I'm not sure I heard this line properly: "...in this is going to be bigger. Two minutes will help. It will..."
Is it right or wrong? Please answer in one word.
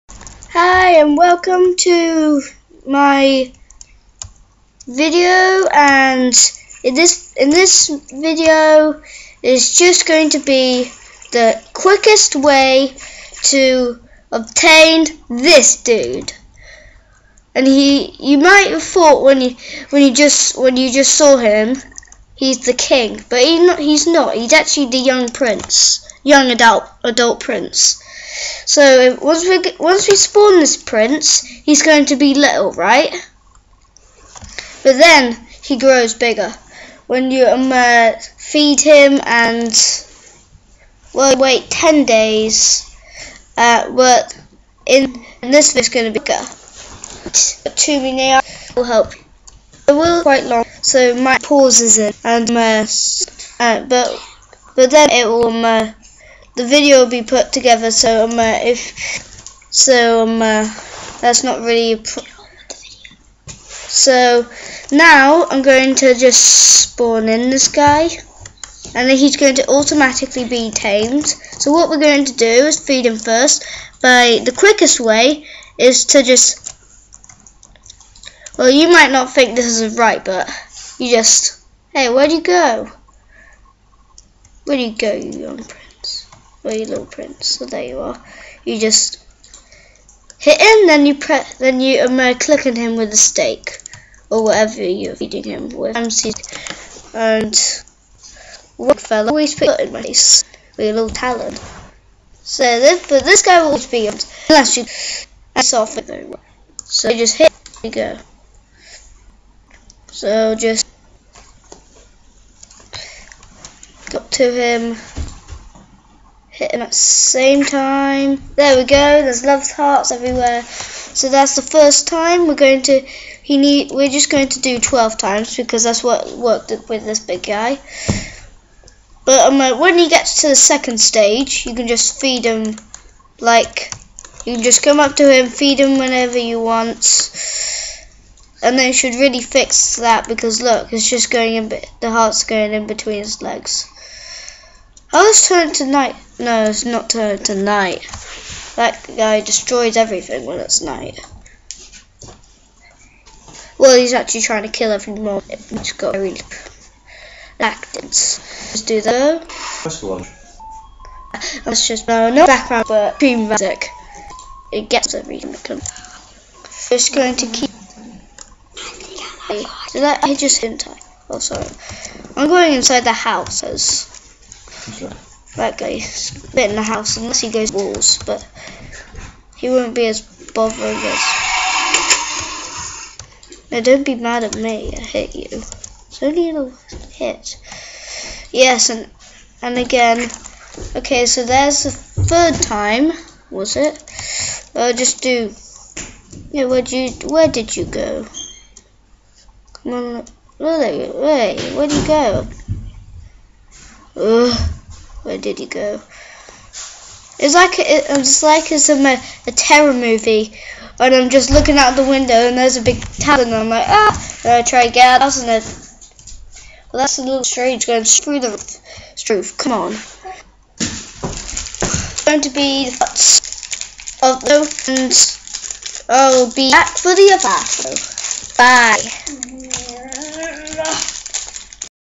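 right.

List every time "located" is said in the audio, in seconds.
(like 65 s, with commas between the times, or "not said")
not said.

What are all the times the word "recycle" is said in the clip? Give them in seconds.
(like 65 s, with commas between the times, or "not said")
not said.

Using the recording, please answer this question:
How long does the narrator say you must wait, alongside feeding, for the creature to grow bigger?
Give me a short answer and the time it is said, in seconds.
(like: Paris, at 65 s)
10 days, at 41 s.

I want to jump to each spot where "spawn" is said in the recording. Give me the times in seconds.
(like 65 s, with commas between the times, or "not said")
30 s, 66 s.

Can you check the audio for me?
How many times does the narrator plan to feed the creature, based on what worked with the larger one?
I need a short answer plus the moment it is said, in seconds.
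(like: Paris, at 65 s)
12, at 124 s.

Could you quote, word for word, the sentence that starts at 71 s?
So what we're going to do is feed him first.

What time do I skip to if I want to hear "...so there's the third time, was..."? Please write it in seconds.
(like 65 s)
191 s.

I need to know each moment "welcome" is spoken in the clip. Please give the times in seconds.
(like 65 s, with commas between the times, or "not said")
1 s.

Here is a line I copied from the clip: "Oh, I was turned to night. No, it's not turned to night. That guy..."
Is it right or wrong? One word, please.
right.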